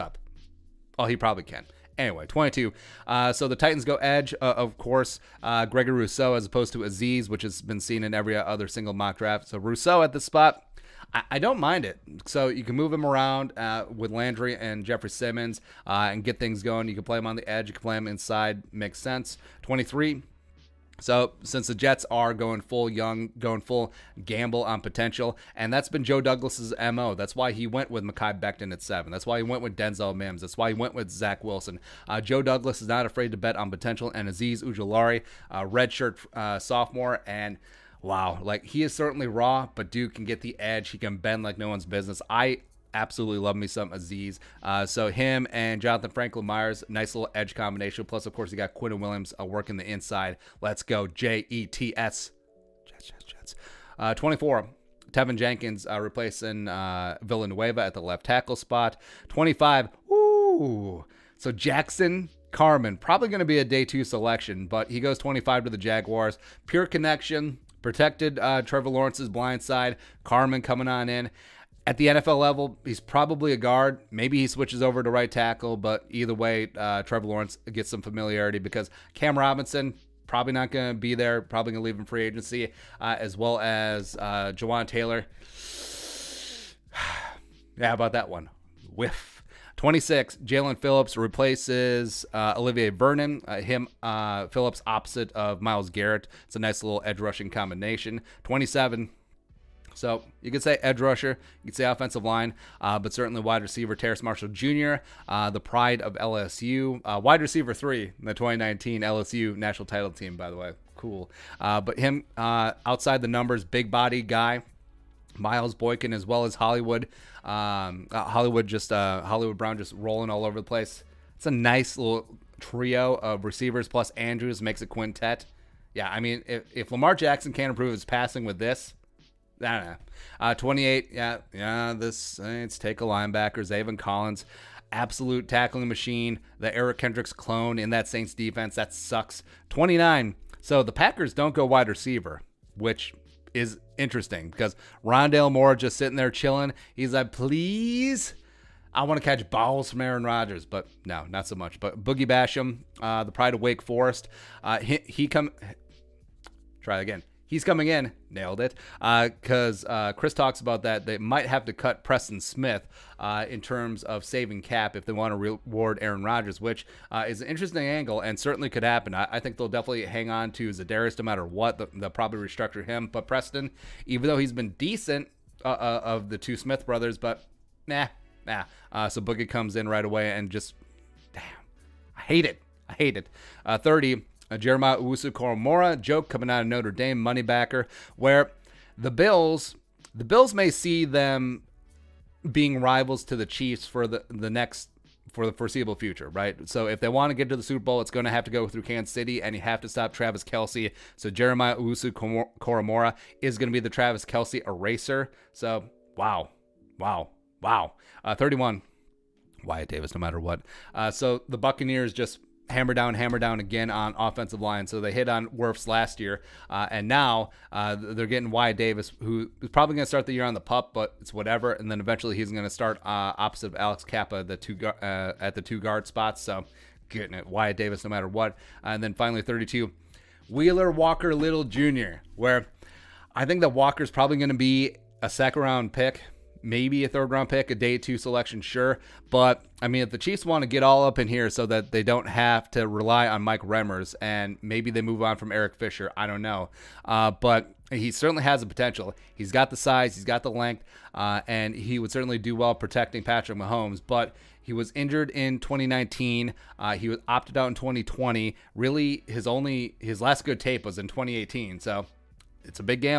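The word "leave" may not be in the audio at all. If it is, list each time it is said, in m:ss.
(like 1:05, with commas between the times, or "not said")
1:21.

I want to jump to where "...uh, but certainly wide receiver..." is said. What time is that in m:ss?
1:42.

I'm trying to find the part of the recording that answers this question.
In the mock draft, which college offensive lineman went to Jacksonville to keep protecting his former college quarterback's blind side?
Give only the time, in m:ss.
1:01.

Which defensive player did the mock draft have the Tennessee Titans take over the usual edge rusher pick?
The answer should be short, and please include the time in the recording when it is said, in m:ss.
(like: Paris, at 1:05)
Gregory Rousseau, at 0:05.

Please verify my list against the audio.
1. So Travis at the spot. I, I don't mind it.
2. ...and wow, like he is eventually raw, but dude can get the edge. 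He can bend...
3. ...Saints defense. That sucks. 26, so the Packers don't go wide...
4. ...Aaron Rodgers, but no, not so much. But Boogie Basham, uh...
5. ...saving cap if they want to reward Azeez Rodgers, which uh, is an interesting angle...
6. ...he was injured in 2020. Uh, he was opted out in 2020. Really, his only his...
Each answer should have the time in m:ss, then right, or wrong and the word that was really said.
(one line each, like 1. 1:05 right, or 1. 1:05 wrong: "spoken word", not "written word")
1. 0:09 wrong: "Rousseau", not "Travis"
2. 0:37 wrong: "certainly", not "eventually"
3. 2:18 wrong: "29", not "26"
4. 2:29 right
5. 2:44 wrong: "Aaron", not "Azeez"
6. 4:14 wrong: "2019", not "2020".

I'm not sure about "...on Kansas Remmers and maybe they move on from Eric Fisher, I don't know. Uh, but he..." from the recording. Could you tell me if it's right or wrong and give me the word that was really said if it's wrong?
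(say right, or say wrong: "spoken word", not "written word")
wrong: "Mike", not "Kansas".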